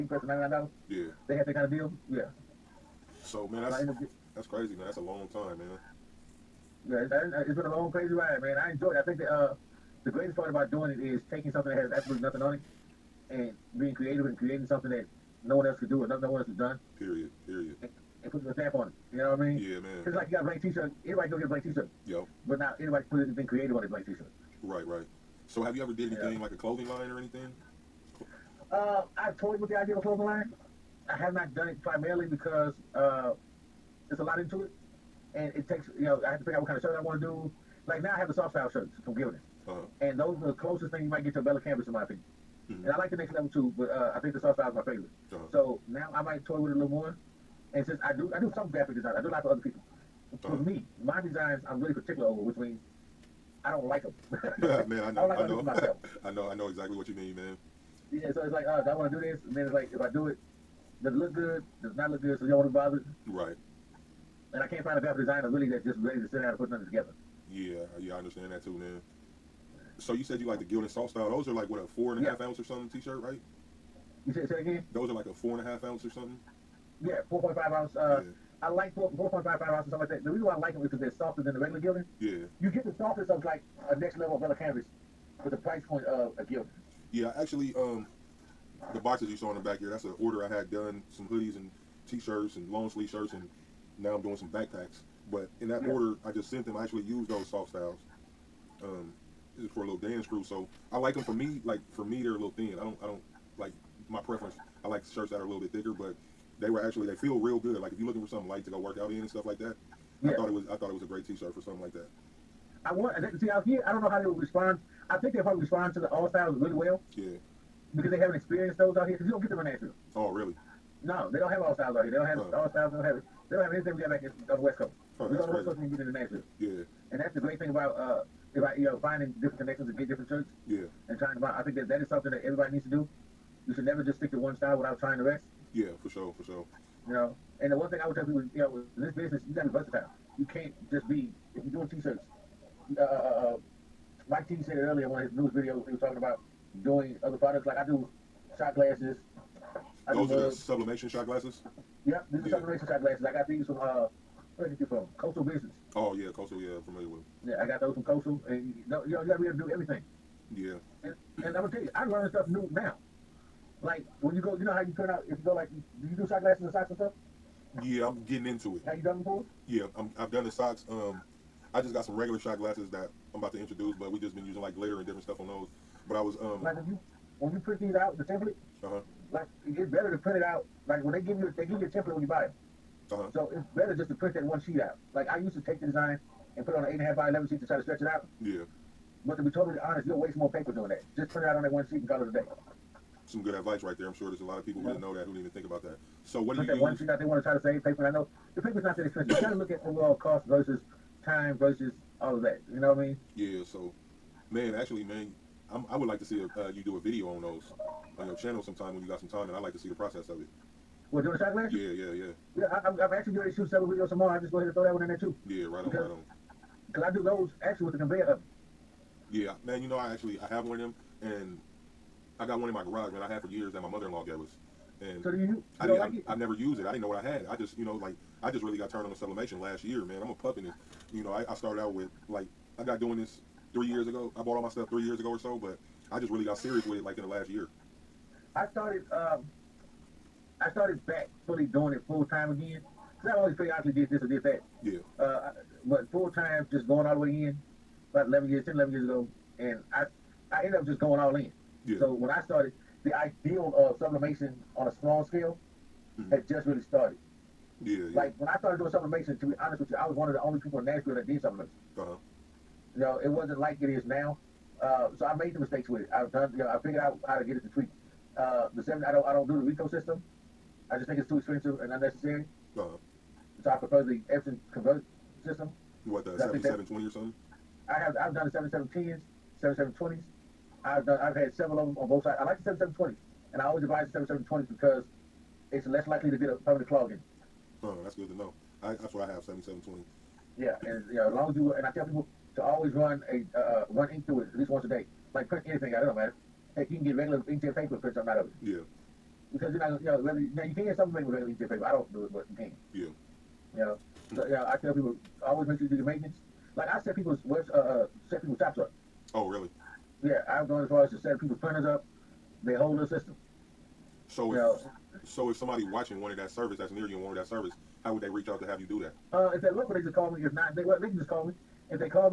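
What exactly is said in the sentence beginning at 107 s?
Like if you're looking for something light to go work out in and stuff like that, yeah.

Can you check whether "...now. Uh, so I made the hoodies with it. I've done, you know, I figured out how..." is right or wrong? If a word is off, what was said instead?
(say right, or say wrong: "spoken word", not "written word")
wrong: "mistakes", not "hoodies".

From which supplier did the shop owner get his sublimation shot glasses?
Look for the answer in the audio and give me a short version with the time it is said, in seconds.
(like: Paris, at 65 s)
Coastal Business, at 155 s.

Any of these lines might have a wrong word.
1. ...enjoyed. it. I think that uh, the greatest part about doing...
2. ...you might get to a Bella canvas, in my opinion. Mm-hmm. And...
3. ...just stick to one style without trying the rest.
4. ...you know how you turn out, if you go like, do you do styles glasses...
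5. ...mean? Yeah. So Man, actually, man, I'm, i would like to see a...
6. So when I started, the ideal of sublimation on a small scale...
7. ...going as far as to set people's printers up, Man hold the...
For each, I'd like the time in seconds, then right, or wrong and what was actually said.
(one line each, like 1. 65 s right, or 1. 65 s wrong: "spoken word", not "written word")
1. 8 s right
2. 41 s right
3. 134 s right
4. 164 s wrong: "sunglasses", not "styles"
5. 203 s right
6. 251 s right
7. 310 s wrong: "They", not "Man".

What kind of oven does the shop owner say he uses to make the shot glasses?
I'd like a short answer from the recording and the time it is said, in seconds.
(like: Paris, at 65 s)
conveyor oven, at 217 s.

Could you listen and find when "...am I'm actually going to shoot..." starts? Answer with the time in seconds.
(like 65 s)
212 s.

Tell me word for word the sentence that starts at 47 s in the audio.
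And since I do, I do some graphic design.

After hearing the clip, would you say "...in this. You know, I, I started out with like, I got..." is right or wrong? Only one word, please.
right.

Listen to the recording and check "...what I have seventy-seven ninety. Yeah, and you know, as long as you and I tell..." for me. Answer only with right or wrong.
wrong.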